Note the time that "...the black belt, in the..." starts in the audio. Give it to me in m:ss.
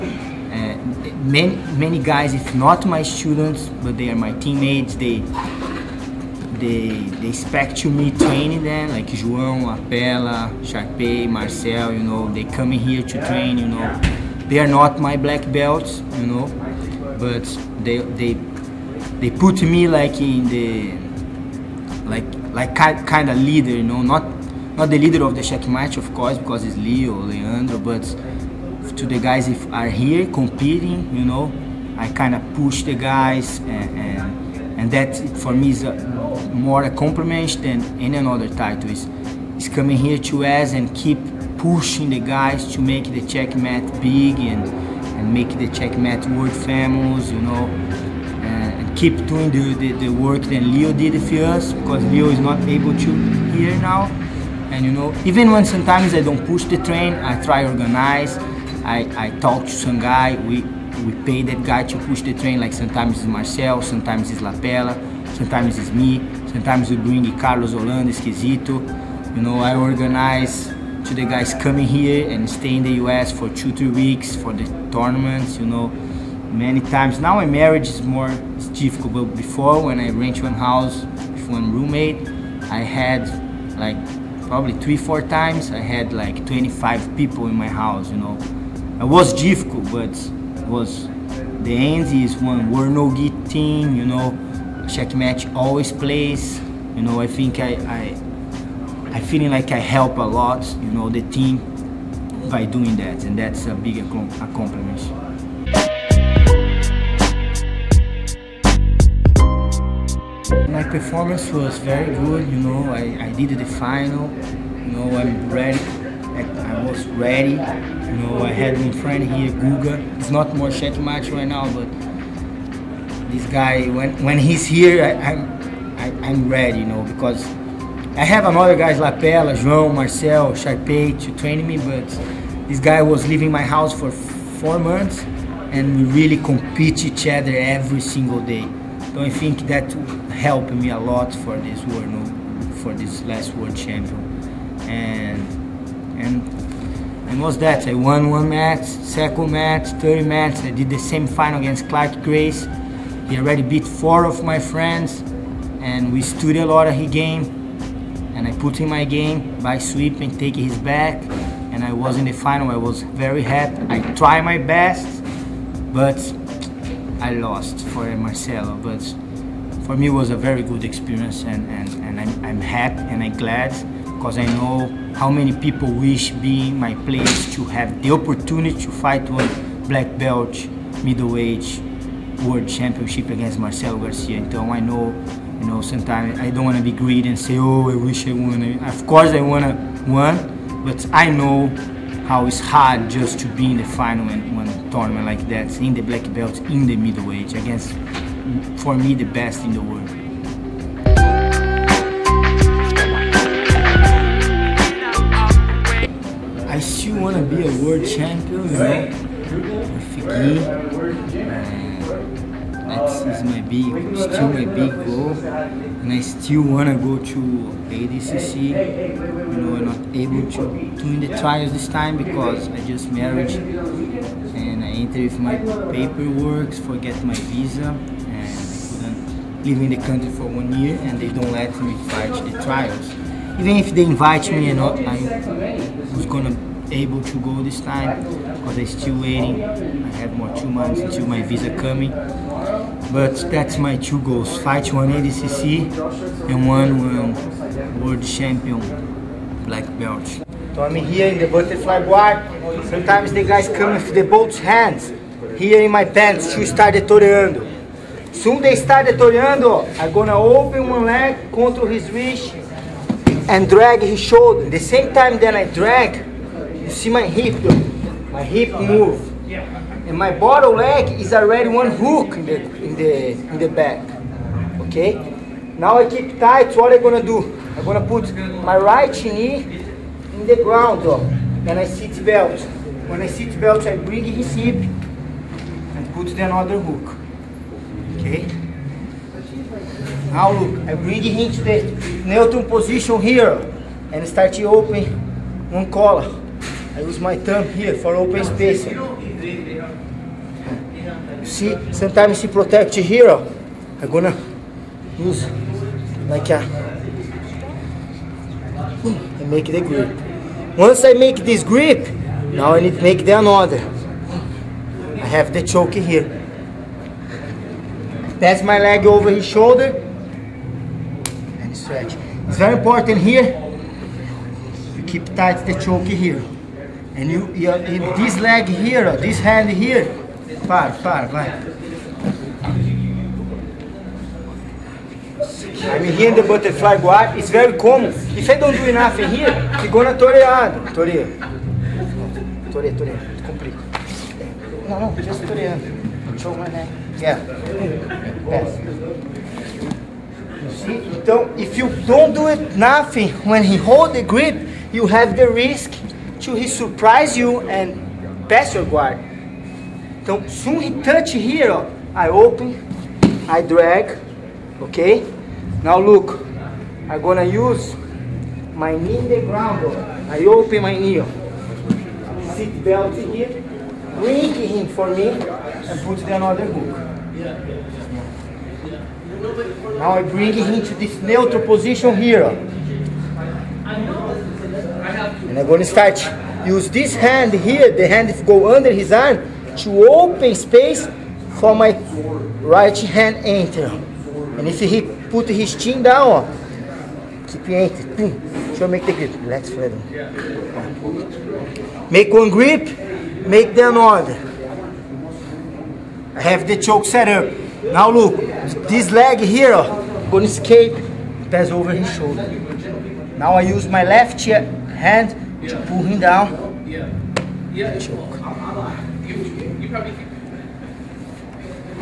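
3:15.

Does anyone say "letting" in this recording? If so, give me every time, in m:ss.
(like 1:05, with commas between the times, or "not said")
not said.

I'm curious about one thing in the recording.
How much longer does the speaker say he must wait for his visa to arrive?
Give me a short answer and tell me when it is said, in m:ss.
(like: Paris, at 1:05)
2 months, at 4:00.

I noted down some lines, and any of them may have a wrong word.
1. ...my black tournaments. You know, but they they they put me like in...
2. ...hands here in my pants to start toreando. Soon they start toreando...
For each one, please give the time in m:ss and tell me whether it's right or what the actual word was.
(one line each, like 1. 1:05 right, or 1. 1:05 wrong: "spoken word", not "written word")
1. 0:14 wrong: "belts", not "tournaments"
2. 4:14 right.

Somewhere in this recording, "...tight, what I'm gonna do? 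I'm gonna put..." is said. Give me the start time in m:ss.
4:36.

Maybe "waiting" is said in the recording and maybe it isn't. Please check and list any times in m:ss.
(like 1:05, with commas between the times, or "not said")
3:59.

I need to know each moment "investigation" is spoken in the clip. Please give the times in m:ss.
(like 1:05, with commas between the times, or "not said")
not said.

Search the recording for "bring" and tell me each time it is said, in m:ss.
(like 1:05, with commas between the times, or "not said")
1:06, 4:43, 4:50, 6:14, 6:20.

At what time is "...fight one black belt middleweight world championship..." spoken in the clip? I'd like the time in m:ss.
2:58.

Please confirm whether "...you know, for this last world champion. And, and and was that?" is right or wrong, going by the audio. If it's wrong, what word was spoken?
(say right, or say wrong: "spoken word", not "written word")
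right.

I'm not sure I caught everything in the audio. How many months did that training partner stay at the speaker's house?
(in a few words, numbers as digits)
4.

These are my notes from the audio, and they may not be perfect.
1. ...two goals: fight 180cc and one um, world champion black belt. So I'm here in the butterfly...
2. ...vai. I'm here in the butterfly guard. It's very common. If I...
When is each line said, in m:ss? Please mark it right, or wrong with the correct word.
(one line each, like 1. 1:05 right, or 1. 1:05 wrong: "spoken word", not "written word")
1. 4:03 right
2. 5:31 right.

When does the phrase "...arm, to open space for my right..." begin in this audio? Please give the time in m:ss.
6:29.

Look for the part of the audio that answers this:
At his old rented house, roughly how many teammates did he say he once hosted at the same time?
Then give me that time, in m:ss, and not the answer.
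1:26.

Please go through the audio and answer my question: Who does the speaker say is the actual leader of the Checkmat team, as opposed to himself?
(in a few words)
Leandro.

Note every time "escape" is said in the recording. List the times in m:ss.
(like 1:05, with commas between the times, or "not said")
6:50.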